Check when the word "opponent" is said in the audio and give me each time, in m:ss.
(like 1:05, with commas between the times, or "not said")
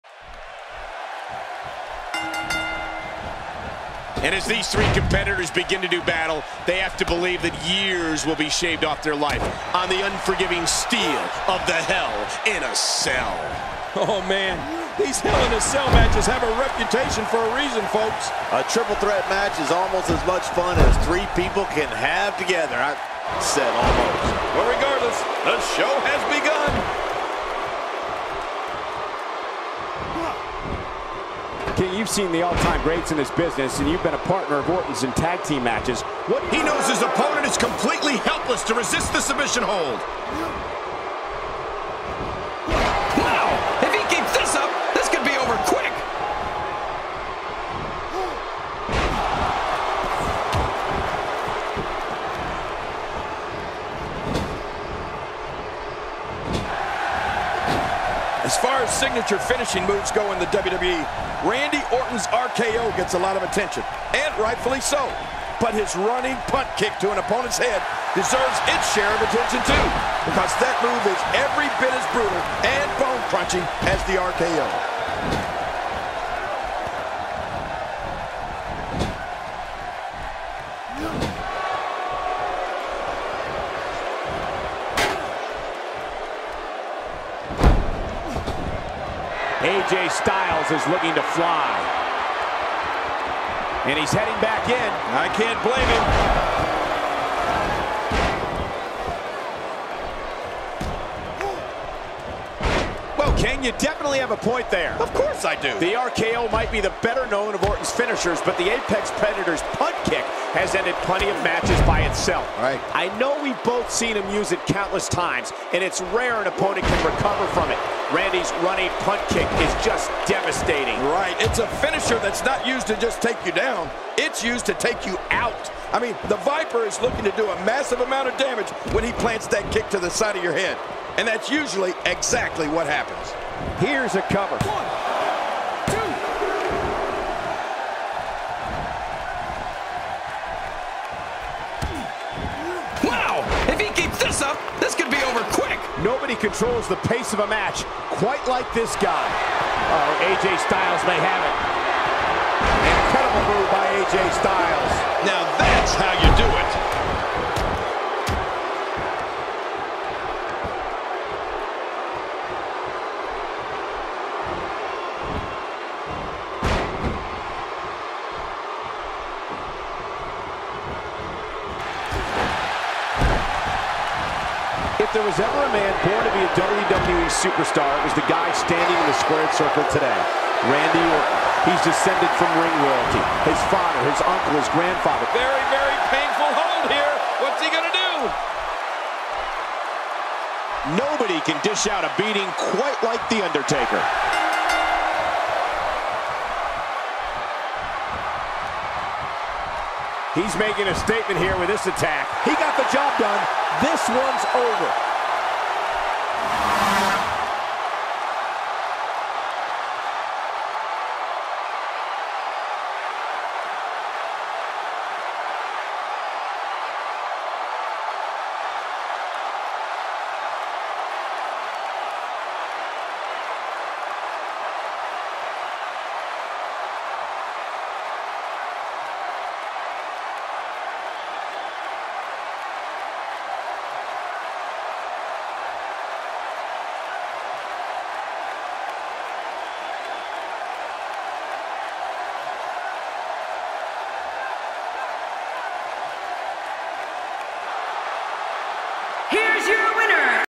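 0:37, 1:07, 1:56.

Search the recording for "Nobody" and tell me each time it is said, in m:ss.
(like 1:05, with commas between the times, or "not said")
2:26, 3:11.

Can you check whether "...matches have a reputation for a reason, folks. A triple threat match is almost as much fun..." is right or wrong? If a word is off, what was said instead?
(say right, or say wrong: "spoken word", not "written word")
right.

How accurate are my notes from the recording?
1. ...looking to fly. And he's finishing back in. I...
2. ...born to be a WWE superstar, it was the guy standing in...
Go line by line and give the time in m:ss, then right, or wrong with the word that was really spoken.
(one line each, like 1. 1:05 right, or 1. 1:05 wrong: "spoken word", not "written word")
1. 1:30 wrong: "heading", not "finishing"
2. 2:56 right.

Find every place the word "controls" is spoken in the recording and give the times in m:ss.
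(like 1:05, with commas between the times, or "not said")
2:26.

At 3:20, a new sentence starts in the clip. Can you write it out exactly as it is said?
He's making a statement here with this attack.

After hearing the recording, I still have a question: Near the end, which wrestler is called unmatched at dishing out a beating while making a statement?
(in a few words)
The Undertaker.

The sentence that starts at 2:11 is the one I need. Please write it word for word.
And that's usually exactly what happens.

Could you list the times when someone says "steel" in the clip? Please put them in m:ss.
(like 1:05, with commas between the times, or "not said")
0:10.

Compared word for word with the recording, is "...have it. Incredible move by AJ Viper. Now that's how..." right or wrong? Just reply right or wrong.
wrong.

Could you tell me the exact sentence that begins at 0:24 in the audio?
Well, regardless, the show has begun.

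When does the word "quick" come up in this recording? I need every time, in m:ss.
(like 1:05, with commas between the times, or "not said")
0:45, 2:25.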